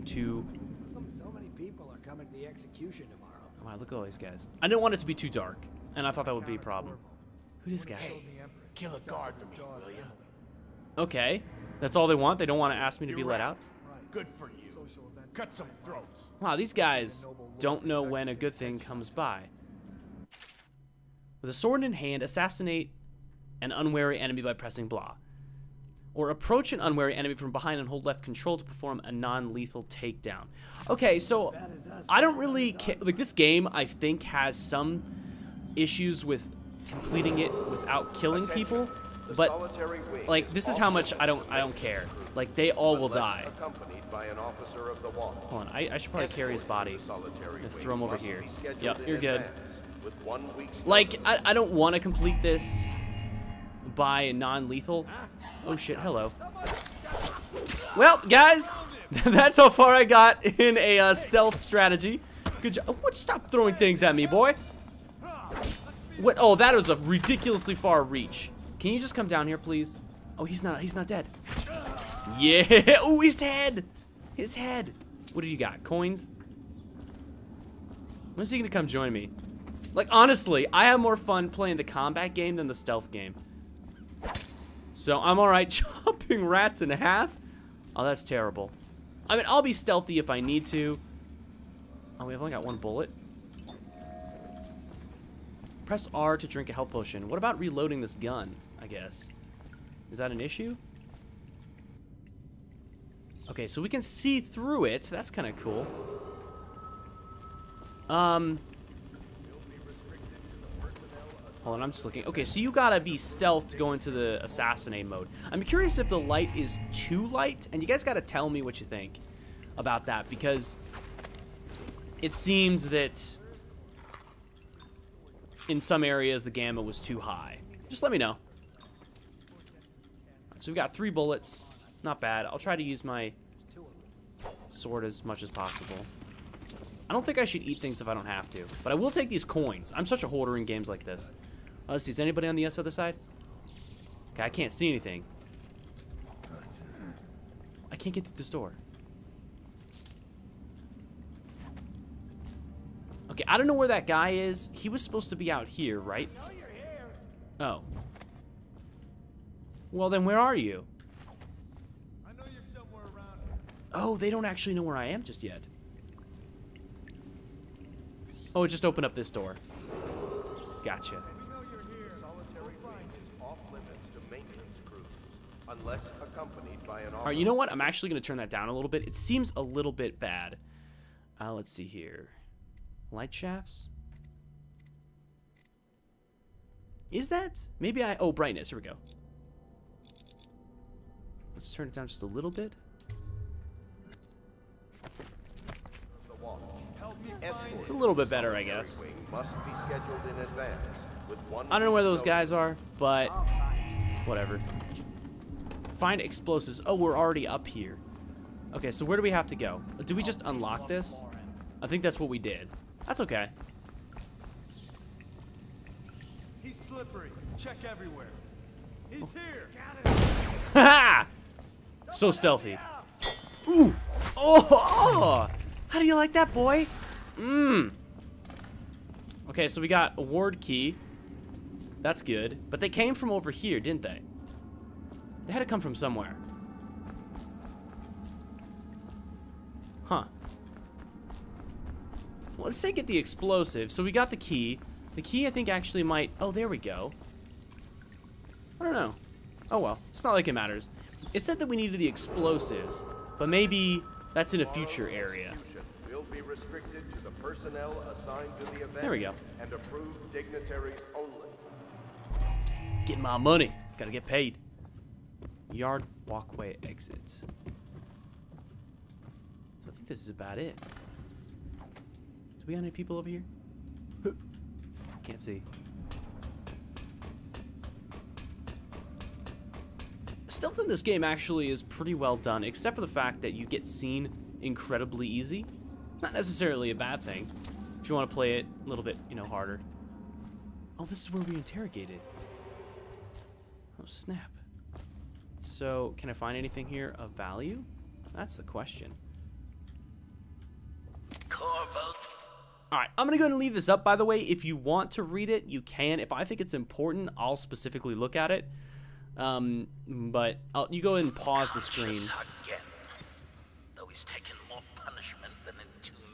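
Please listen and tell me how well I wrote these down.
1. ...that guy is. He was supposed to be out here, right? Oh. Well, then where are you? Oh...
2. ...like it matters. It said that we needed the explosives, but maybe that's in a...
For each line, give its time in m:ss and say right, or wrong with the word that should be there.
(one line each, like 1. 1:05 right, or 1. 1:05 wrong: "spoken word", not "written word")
1. 2:33 right
2. 4:10 right.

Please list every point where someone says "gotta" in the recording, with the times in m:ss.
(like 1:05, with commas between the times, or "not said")
1:52, 1:58, 4:23.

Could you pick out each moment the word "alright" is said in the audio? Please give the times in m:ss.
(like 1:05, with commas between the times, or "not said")
1:25, 5:02.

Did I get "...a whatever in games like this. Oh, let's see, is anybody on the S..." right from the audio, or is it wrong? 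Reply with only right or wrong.
wrong.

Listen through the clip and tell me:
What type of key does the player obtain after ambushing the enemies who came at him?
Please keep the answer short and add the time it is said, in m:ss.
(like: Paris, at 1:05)
Ward key, at 3:50.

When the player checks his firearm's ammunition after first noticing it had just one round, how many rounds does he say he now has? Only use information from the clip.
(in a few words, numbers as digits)
3.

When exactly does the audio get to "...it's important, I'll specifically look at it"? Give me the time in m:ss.
5:06.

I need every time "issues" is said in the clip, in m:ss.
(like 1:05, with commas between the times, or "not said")
0:35, 1:40.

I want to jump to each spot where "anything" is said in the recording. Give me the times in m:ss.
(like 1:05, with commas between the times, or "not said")
2:24, 4:56.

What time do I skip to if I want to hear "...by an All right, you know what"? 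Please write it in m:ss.
2:56.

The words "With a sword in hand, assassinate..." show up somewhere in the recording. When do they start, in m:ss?
0:21.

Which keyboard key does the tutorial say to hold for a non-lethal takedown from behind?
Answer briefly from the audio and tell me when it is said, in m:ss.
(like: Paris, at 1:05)
Left control, at 0:28.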